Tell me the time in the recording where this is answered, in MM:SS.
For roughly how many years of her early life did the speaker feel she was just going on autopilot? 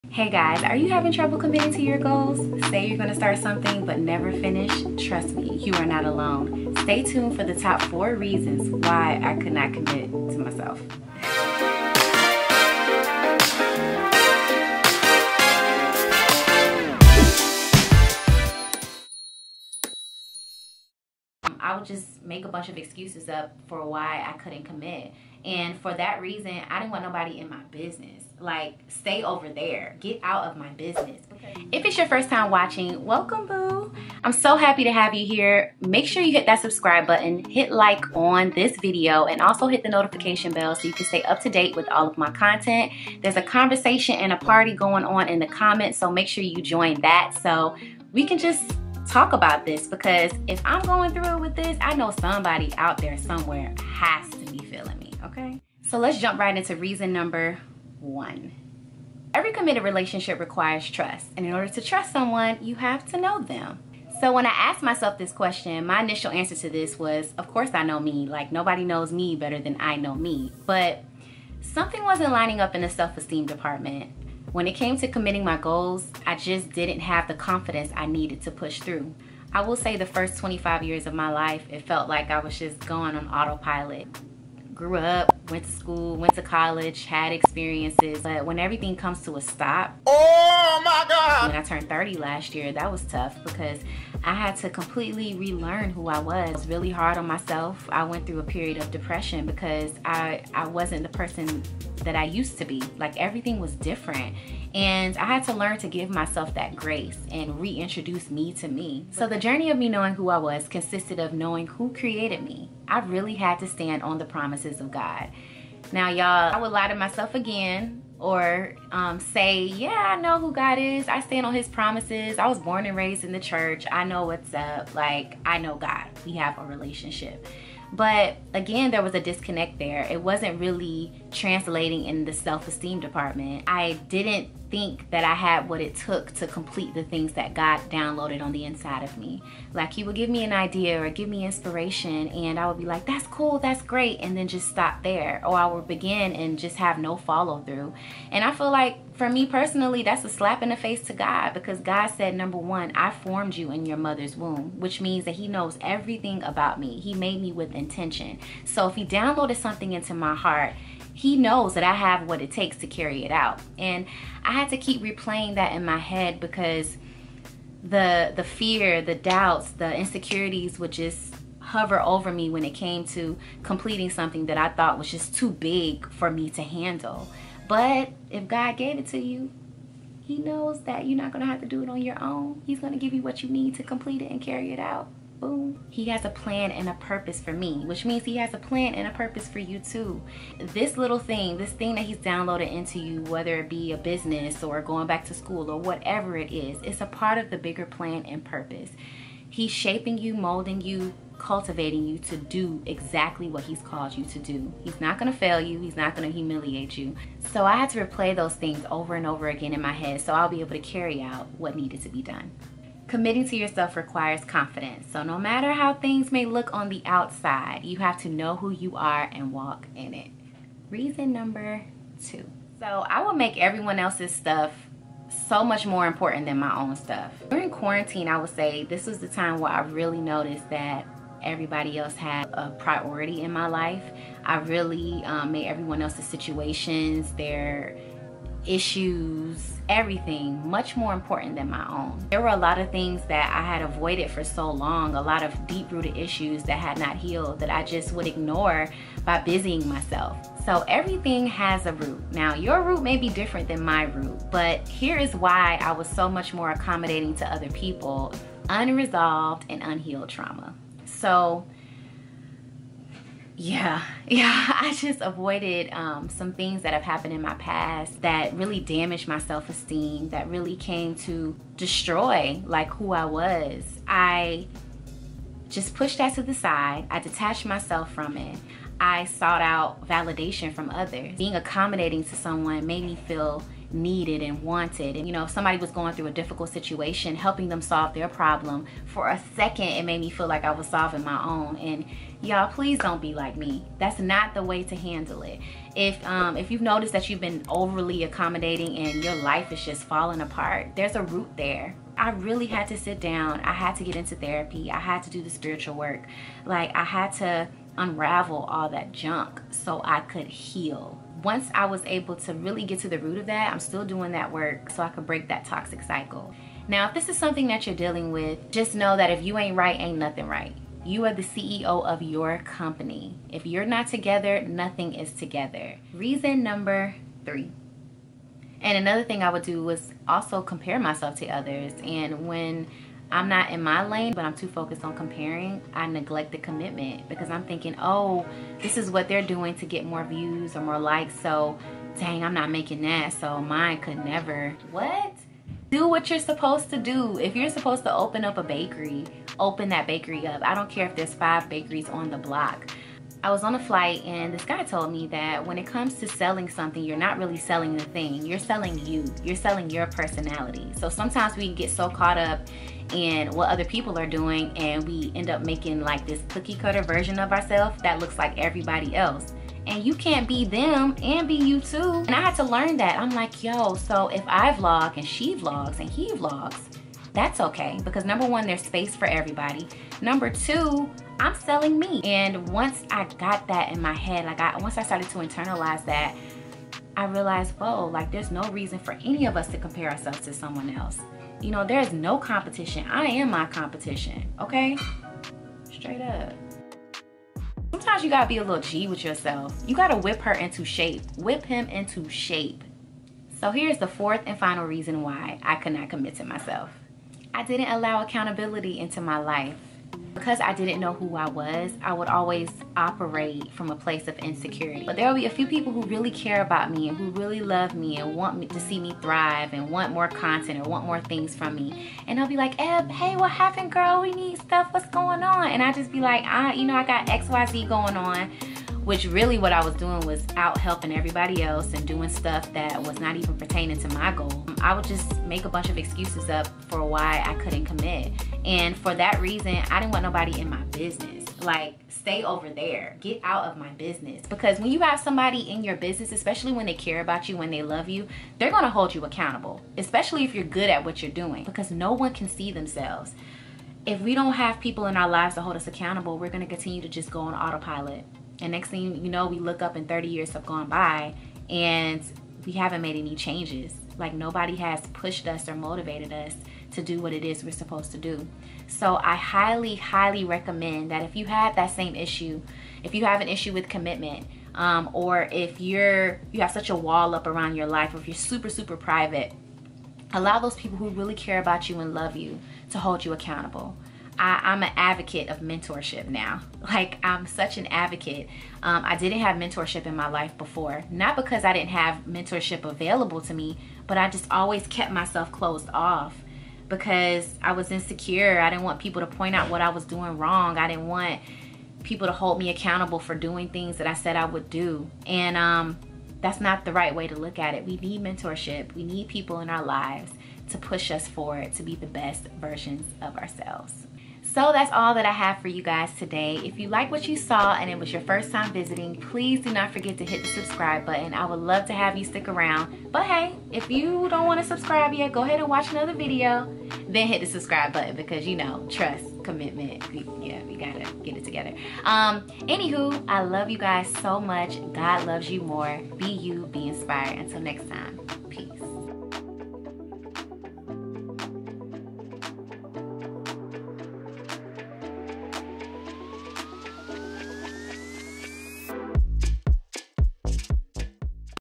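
01:20.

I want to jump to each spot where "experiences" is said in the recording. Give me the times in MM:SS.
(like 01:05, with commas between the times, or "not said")
01:27.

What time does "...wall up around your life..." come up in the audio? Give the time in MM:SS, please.
07:56.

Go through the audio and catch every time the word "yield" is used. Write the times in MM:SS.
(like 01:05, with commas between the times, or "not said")
not said.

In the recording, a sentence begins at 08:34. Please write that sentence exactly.
So that's all that I have for you guys today.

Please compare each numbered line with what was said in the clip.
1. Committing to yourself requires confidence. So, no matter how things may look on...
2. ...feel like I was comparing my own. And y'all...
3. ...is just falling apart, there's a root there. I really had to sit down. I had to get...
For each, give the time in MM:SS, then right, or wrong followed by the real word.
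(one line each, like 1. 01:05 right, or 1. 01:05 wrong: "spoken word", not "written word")
1. 03:33 right
2. 04:50 wrong: "solving", not "comparing"
3. 04:59 right.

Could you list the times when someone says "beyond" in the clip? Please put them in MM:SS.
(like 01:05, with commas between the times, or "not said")
not said.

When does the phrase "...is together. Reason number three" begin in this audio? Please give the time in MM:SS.
05:25.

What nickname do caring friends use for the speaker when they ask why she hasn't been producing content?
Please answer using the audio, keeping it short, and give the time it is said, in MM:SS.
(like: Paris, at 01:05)
Eb, at 07:02.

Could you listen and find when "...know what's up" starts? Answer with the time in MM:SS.
02:04.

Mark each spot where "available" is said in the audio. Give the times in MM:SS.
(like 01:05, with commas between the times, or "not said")
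08:12.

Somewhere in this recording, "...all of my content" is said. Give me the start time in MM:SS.
00:41.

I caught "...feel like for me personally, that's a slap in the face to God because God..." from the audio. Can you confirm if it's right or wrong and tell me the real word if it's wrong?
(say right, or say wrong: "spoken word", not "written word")
right.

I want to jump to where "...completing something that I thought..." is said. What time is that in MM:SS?
02:53.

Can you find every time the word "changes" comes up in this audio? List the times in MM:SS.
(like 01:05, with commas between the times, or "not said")
07:43.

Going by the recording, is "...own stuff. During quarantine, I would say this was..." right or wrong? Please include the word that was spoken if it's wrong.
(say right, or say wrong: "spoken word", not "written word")
right.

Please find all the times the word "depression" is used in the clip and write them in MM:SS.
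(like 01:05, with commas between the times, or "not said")
01:38.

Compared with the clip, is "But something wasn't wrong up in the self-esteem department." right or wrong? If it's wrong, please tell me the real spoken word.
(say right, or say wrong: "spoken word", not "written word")
wrong: "lining", not "wrong".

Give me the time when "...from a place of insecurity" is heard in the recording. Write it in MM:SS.
06:53.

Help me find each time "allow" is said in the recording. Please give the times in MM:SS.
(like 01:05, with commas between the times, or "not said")
06:47, 08:00.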